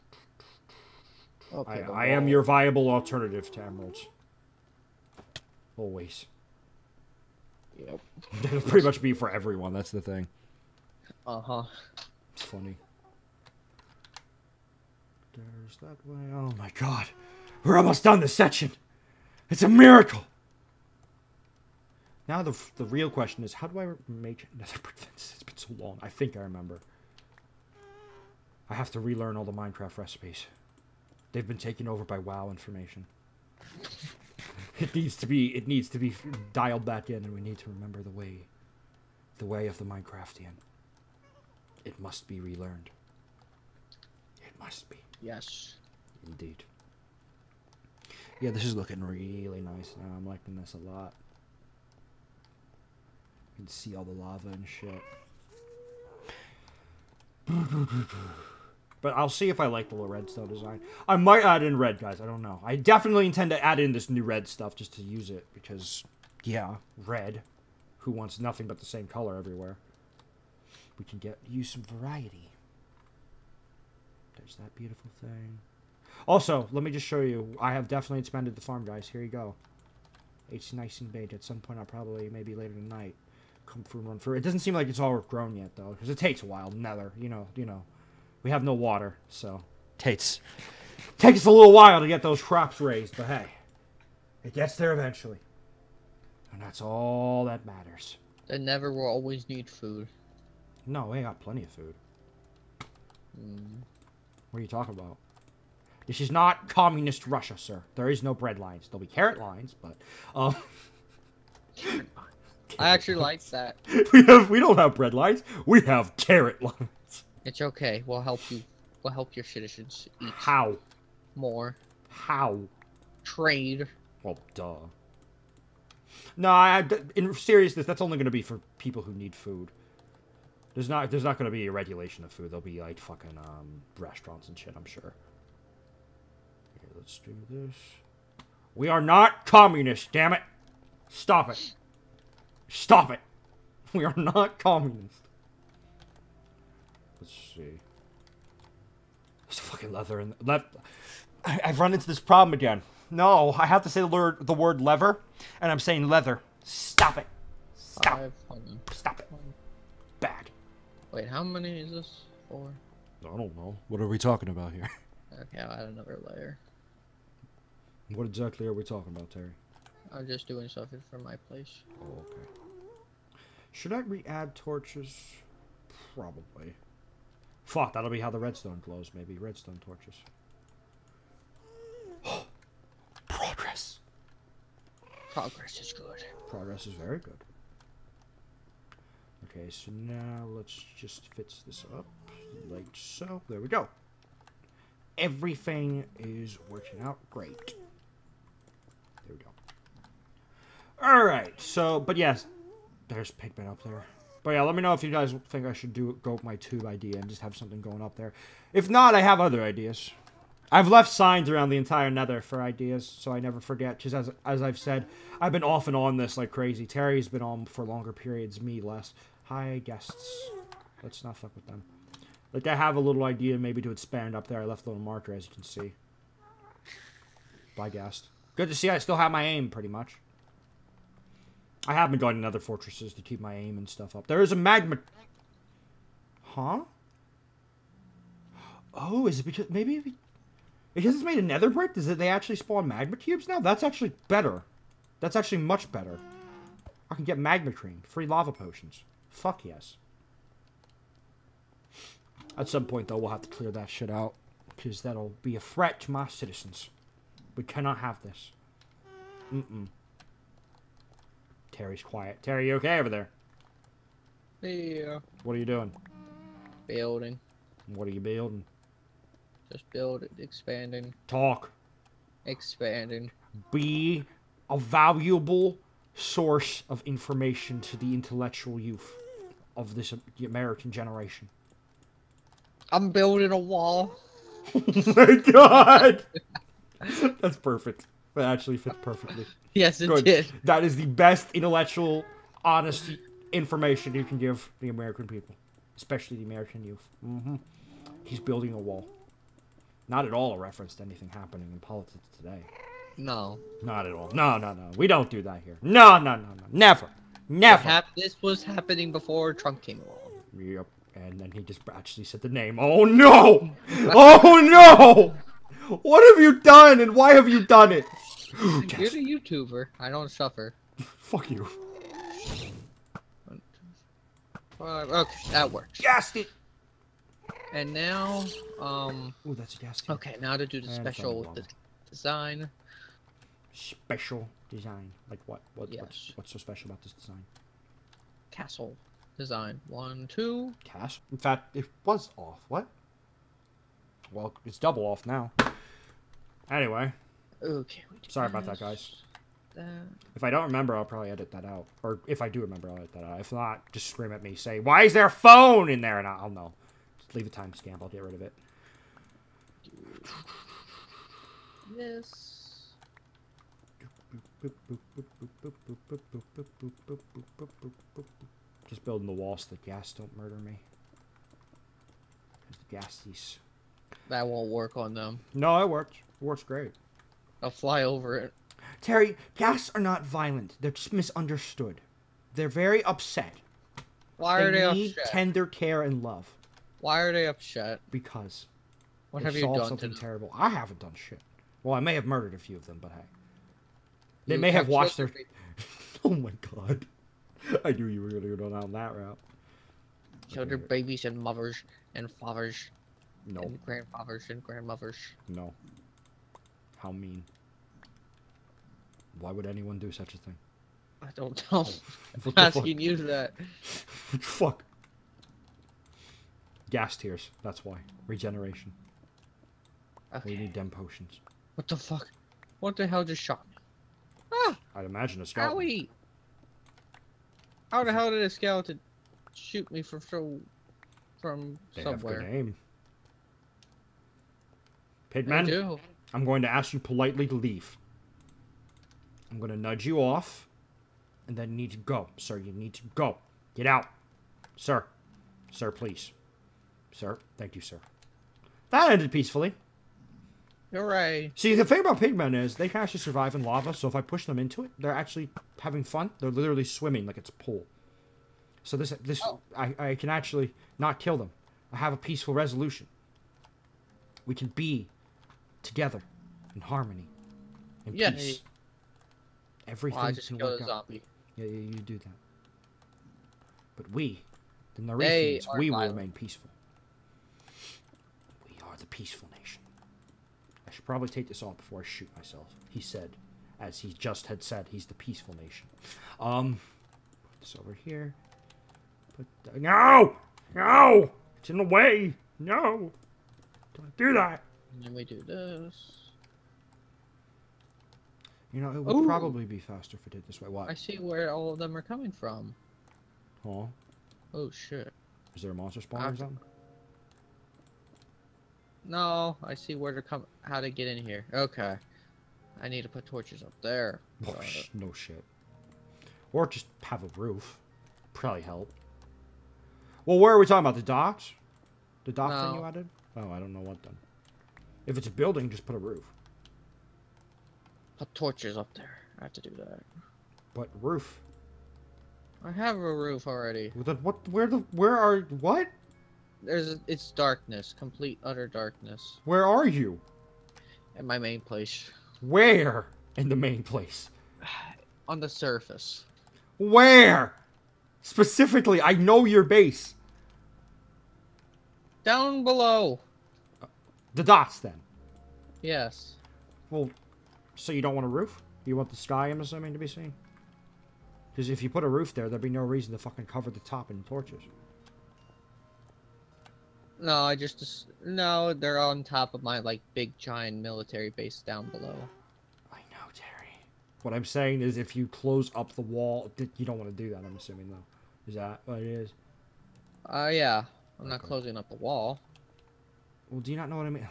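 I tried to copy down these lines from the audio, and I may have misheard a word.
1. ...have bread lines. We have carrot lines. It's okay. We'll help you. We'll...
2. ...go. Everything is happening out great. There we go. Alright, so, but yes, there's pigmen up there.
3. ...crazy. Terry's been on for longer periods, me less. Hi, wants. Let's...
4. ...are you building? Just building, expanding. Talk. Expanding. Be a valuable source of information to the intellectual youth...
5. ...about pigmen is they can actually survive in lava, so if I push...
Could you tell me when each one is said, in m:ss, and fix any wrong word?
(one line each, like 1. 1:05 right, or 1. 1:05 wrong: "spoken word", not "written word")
1. 1:54 right
2. 3:13 wrong: "working", not "happening"
3. 3:36 wrong: "ghasts", not "wants"
4. 4:28 right
5. 7:31 right.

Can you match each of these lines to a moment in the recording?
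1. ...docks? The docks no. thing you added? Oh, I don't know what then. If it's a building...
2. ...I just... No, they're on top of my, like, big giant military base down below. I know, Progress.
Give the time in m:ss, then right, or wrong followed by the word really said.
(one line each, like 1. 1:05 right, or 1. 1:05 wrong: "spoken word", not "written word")
1. 8:41 right
2. 9:27 wrong: "Terry", not "Progress".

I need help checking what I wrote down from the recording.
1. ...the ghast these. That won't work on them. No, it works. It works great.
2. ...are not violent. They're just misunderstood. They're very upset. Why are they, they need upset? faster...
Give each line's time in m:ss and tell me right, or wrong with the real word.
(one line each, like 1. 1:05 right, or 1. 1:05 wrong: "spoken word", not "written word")
1. 6:12 right
2. 6:19 wrong: "tender", not "faster".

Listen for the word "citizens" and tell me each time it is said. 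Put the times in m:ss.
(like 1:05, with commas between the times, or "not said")
1:59, 4:16.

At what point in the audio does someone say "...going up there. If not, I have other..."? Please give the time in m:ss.
3:27.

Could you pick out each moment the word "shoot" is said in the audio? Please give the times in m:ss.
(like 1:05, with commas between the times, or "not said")
7:09, 8:02.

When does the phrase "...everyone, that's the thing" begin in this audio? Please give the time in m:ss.
0:09.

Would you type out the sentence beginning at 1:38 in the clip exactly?
They never will always need food.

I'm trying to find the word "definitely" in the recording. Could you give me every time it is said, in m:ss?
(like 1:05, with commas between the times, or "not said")
1:02, 1:17.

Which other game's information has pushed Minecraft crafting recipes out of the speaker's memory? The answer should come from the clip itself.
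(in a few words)
WoW.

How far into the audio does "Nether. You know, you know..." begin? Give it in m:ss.
1:26.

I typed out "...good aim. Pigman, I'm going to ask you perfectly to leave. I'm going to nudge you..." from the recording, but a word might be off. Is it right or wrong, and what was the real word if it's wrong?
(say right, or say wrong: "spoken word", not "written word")
wrong: "politely", not "perfectly".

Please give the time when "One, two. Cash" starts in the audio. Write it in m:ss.
5:39.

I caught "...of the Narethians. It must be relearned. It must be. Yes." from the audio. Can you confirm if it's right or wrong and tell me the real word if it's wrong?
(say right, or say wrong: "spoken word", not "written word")
wrong: "Minecraftian", not "Narethians".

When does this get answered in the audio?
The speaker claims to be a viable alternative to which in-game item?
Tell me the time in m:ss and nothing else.
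0:03.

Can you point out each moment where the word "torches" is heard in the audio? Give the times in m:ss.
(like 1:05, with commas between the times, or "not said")
2:54, 2:59, 8:33, 8:48, 9:24.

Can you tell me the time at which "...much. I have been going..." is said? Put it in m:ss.
3:49.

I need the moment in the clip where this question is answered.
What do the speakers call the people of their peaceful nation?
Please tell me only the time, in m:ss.
7:55.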